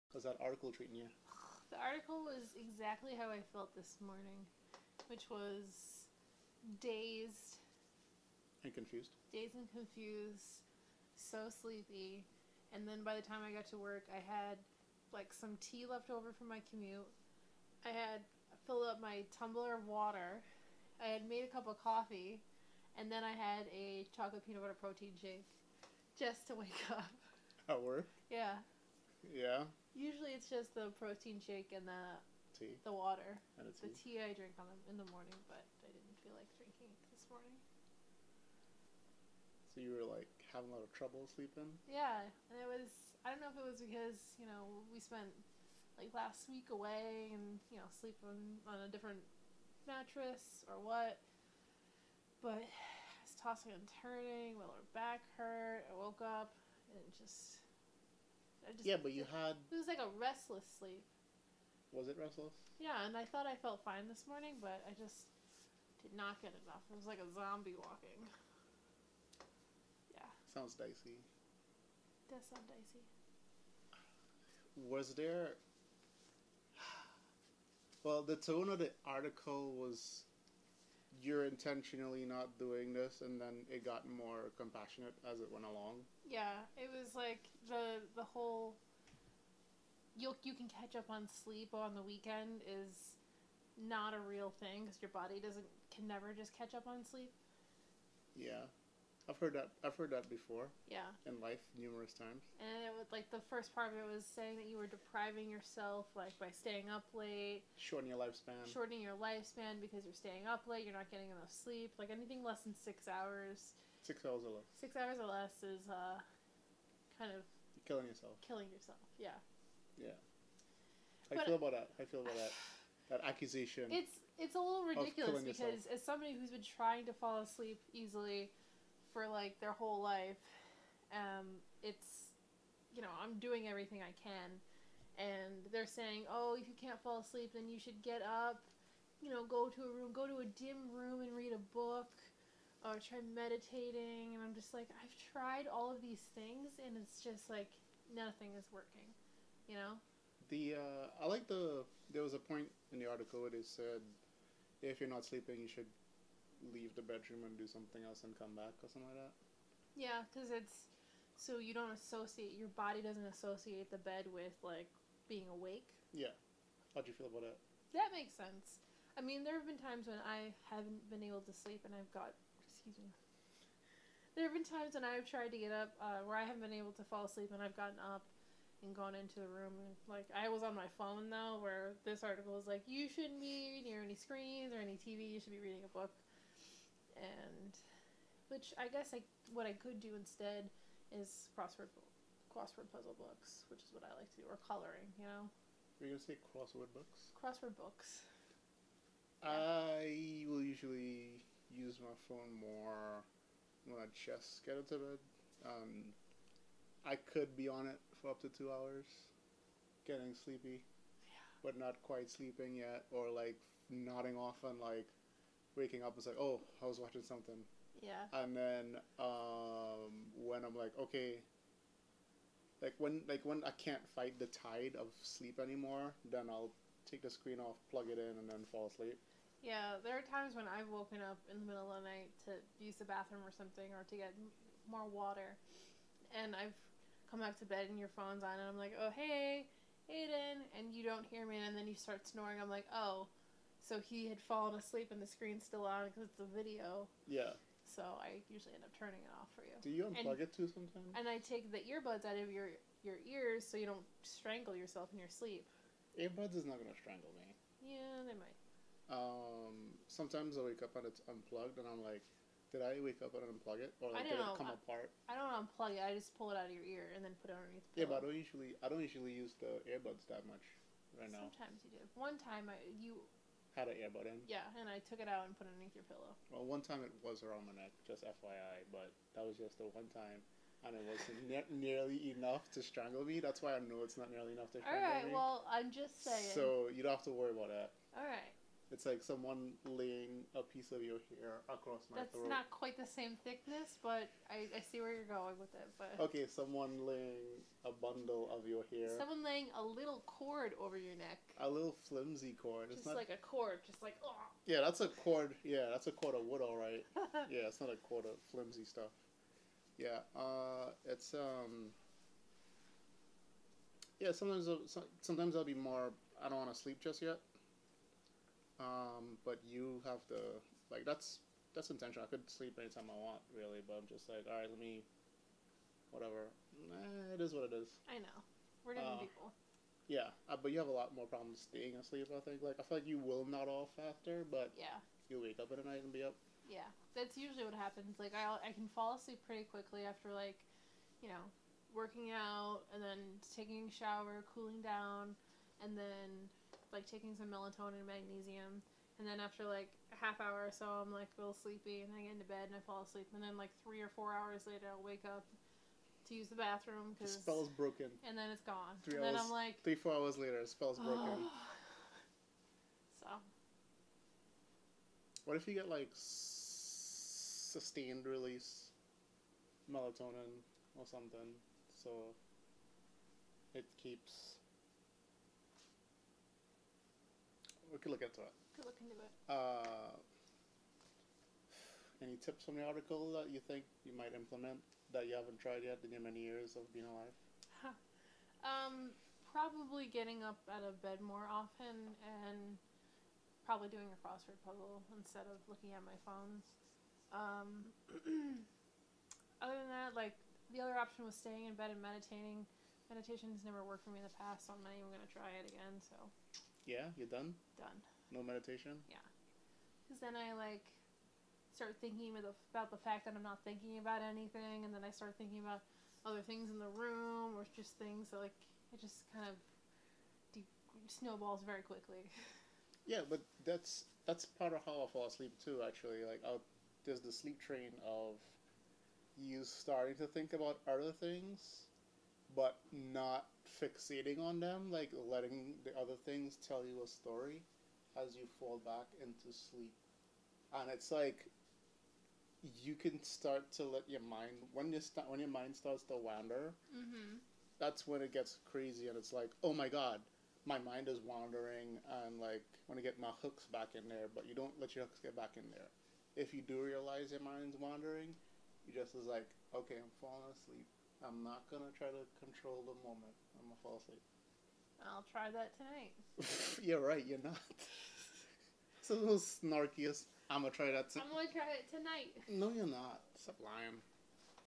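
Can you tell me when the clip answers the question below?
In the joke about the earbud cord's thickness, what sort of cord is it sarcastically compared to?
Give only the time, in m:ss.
5:06.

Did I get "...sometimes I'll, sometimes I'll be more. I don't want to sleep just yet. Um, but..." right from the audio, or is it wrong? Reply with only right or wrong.
right.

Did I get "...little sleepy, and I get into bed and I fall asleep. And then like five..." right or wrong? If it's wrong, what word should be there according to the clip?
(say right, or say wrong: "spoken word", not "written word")
wrong: "three", not "five".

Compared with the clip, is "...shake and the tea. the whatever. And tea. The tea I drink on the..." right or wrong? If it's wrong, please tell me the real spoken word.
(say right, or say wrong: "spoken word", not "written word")
wrong: "water", not "whatever".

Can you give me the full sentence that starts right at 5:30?
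Yeah, uh, but you have a lot more problems staying asleep.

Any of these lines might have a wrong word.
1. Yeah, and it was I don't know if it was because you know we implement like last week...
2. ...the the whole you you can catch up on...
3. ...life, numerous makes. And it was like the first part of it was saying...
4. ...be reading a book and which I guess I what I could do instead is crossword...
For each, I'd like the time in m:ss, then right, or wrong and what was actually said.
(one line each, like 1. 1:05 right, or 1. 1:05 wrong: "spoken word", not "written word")
1. 0:41 wrong: "spent", not "implement"
2. 1:27 right
3. 1:41 wrong: "times", not "makes"
4. 3:05 right.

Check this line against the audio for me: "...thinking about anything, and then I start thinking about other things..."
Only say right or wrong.
right.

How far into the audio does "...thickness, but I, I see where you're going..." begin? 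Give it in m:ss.
4:53.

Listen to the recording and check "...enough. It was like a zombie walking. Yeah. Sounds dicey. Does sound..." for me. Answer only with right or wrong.
right.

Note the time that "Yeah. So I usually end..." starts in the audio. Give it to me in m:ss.
4:07.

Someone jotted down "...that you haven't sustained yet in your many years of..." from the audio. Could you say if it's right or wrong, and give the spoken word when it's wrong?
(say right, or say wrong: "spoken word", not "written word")
wrong: "tried", not "sustained".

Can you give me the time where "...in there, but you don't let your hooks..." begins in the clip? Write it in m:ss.
7:33.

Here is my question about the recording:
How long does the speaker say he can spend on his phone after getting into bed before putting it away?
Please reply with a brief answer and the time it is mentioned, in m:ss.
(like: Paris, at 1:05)
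up to 2 hours, at 3:28.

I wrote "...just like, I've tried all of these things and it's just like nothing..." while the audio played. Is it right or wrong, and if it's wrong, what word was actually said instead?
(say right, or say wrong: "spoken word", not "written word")
right.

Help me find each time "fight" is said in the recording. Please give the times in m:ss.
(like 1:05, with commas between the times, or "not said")
3:44.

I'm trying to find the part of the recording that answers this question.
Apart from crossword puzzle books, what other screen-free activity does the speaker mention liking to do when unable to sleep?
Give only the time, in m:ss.
3:14.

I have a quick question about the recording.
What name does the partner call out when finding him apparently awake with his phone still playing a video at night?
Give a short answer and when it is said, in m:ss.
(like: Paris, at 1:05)
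Aiden, at 4:00.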